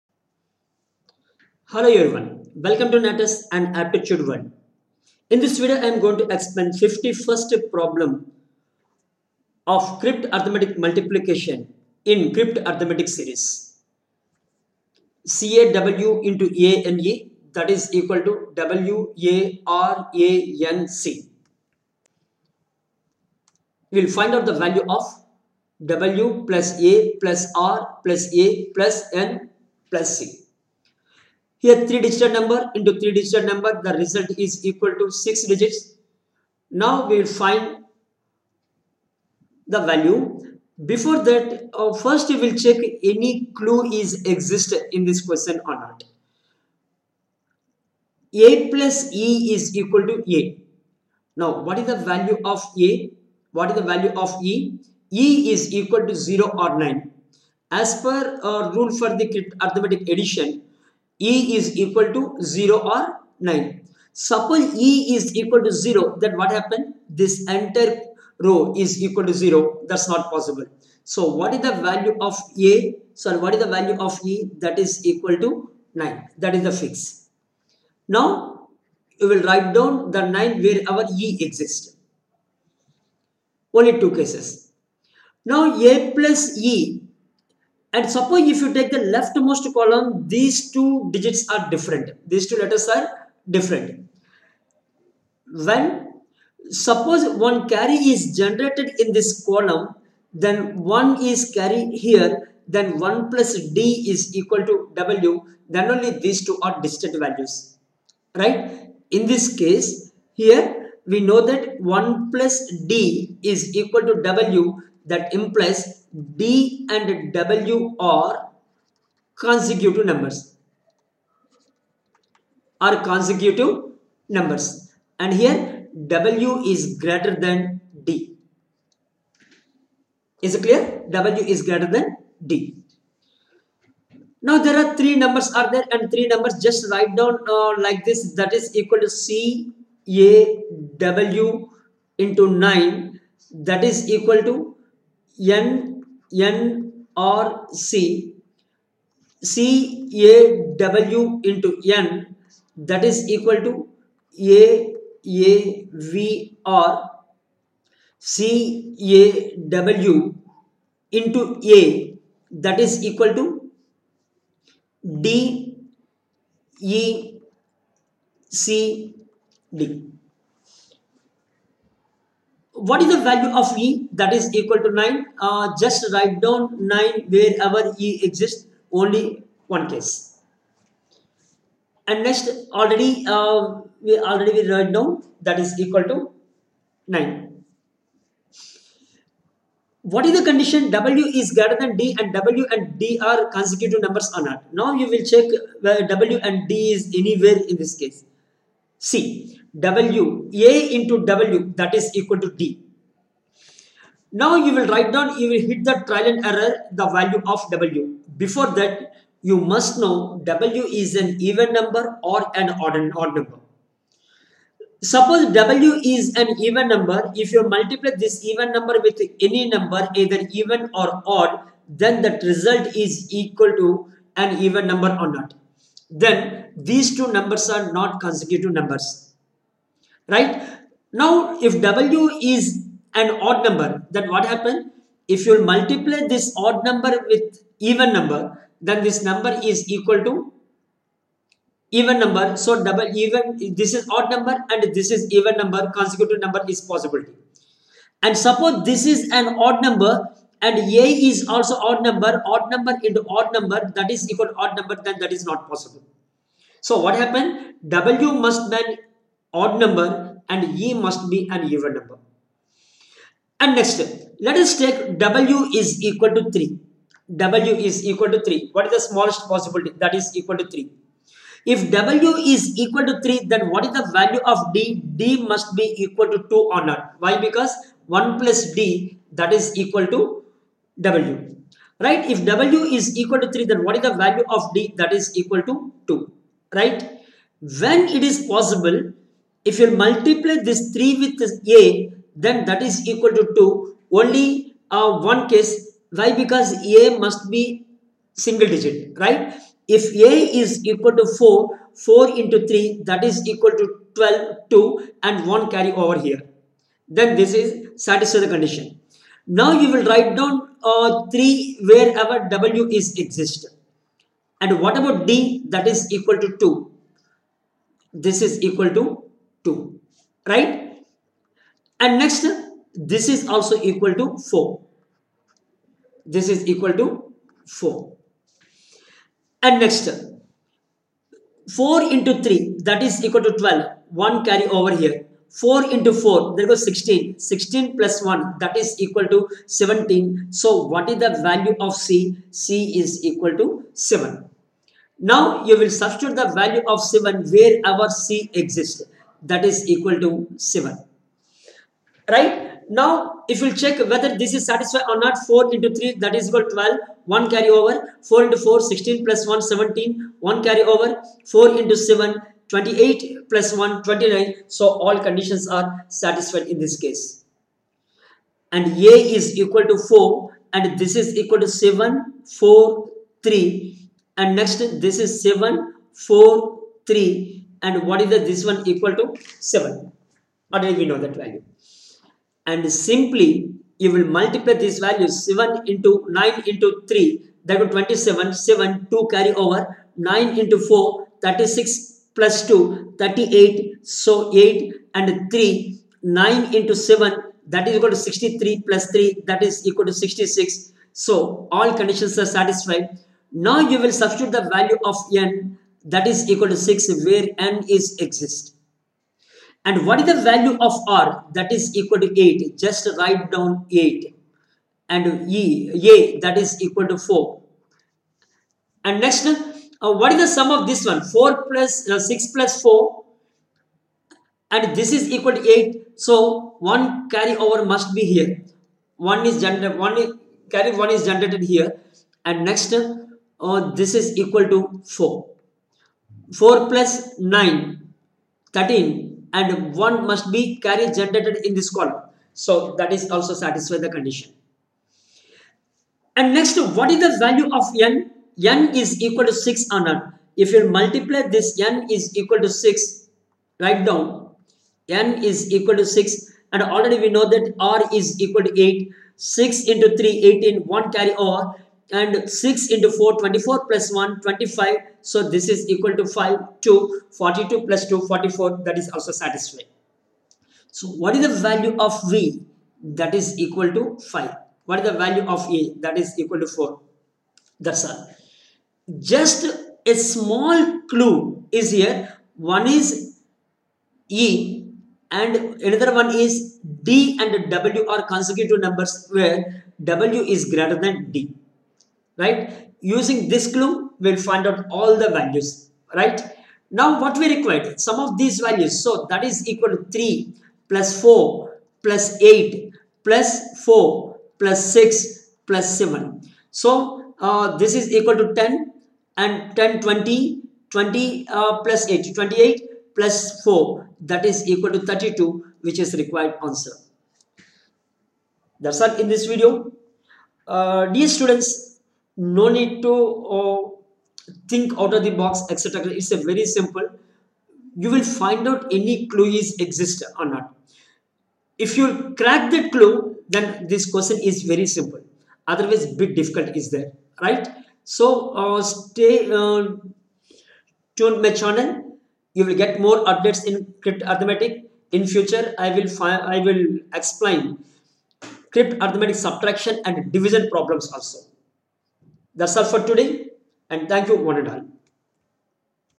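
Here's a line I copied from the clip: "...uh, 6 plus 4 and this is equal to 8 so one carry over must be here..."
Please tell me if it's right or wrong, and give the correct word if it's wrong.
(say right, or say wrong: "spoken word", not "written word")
right.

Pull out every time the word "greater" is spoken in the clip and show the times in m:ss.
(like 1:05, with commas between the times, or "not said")
2:06, 2:11, 3:11, 8:10.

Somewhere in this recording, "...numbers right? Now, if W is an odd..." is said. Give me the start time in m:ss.
3:48.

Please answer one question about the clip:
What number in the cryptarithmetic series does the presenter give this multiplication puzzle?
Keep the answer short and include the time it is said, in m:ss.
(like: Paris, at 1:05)
51st, at 0:06.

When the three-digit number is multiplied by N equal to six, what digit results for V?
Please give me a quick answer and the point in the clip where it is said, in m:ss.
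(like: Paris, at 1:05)
5, at 7:51.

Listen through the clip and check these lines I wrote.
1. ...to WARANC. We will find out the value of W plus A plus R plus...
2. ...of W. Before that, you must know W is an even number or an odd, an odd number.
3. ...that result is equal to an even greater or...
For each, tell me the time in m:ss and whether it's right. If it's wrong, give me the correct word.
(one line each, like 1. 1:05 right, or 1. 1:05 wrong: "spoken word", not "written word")
1. 0:18 right
2. 3:27 right
3. 3:42 wrong: "number", not "greater".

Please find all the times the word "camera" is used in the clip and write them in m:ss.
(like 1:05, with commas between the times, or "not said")
not said.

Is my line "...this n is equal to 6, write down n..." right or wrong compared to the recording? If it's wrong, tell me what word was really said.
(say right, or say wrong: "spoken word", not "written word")
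right.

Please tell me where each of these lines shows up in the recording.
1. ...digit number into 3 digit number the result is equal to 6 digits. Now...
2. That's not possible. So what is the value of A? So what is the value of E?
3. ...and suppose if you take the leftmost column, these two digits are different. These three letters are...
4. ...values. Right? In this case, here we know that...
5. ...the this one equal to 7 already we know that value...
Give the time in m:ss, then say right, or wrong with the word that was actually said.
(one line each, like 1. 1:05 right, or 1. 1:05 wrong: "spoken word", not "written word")
1. 0:32 right
2. 1:09 right
3. 1:27 wrong: "two", not "three"
4. 1:47 right
5. 6:18 right.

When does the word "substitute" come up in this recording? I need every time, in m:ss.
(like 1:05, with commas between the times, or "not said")
5:46, 6:44.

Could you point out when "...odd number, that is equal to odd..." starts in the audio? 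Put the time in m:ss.
4:13.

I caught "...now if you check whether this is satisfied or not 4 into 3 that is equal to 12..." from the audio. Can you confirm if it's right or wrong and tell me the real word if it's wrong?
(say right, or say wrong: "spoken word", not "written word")
right.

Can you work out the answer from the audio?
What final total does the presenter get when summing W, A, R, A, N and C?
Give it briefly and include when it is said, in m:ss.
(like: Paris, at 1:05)
32, at 8:34.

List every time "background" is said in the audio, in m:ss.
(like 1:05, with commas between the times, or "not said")
not said.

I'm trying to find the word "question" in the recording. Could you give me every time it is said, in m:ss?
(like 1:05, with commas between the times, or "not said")
0:45, 8:54.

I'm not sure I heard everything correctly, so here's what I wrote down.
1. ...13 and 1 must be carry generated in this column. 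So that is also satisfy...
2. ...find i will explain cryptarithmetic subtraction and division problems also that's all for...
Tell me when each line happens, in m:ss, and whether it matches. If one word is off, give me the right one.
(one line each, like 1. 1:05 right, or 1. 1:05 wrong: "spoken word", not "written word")
1. 7:18 right
2. 9:06 right.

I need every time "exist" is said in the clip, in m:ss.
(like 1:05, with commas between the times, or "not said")
0:44, 1:21, 2:58, 5:13, 5:48, 6:48, 8:49.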